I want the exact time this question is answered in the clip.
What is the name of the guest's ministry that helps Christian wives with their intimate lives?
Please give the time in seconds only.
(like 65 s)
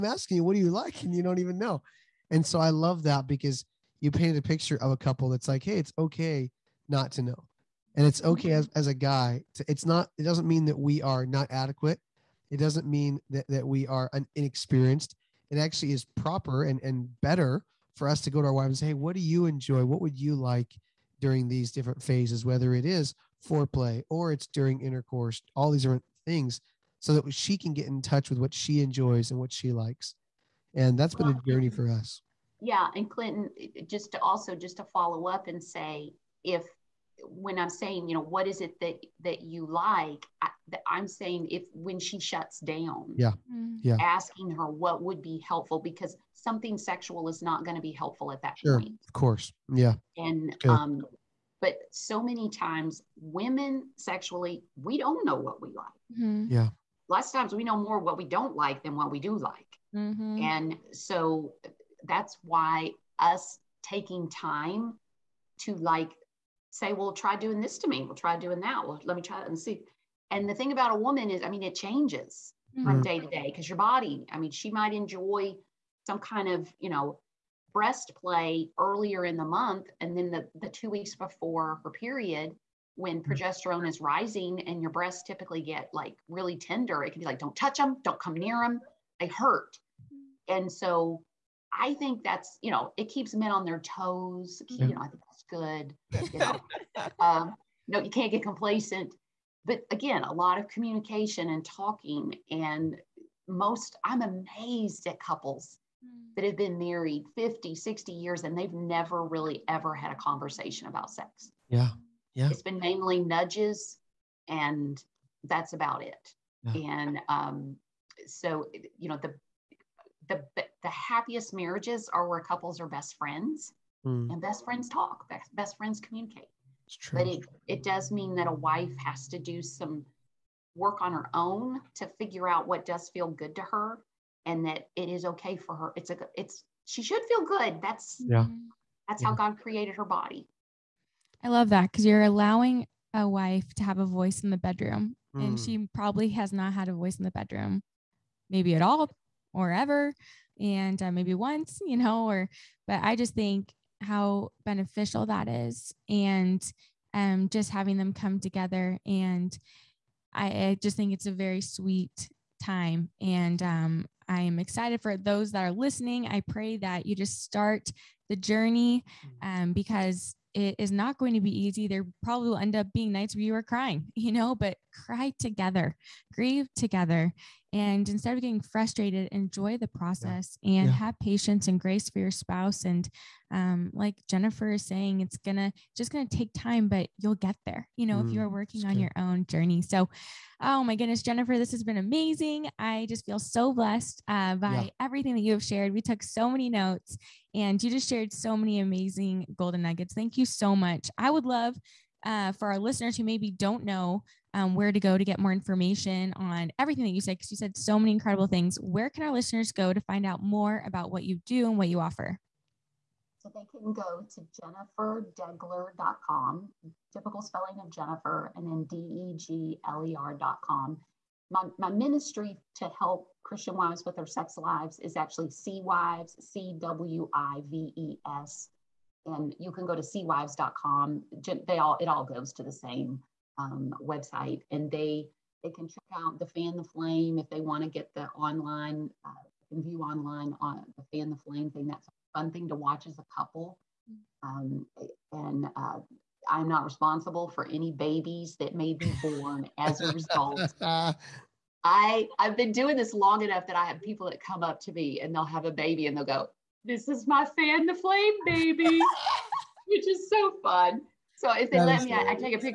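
225 s.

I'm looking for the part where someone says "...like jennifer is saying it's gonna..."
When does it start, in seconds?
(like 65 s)
183 s.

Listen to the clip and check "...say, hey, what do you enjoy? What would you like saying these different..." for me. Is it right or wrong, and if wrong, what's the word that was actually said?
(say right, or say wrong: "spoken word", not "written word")
wrong: "during", not "saying".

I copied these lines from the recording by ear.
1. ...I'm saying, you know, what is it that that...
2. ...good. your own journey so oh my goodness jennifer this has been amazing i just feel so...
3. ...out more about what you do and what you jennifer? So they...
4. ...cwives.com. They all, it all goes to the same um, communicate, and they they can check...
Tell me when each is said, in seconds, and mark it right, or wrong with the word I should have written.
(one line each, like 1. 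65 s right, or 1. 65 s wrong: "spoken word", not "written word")
1. 37 s right
2. 188 s right
3. 210 s wrong: "offer", not "jennifer"
4. 230 s wrong: "website", not "communicate".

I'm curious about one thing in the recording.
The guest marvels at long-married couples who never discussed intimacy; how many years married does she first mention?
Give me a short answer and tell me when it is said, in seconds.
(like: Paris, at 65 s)
50, at 107 s.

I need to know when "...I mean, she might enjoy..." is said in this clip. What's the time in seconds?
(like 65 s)
74 s.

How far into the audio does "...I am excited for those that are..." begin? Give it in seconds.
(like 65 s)
164 s.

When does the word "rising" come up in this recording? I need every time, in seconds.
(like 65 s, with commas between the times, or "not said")
83 s.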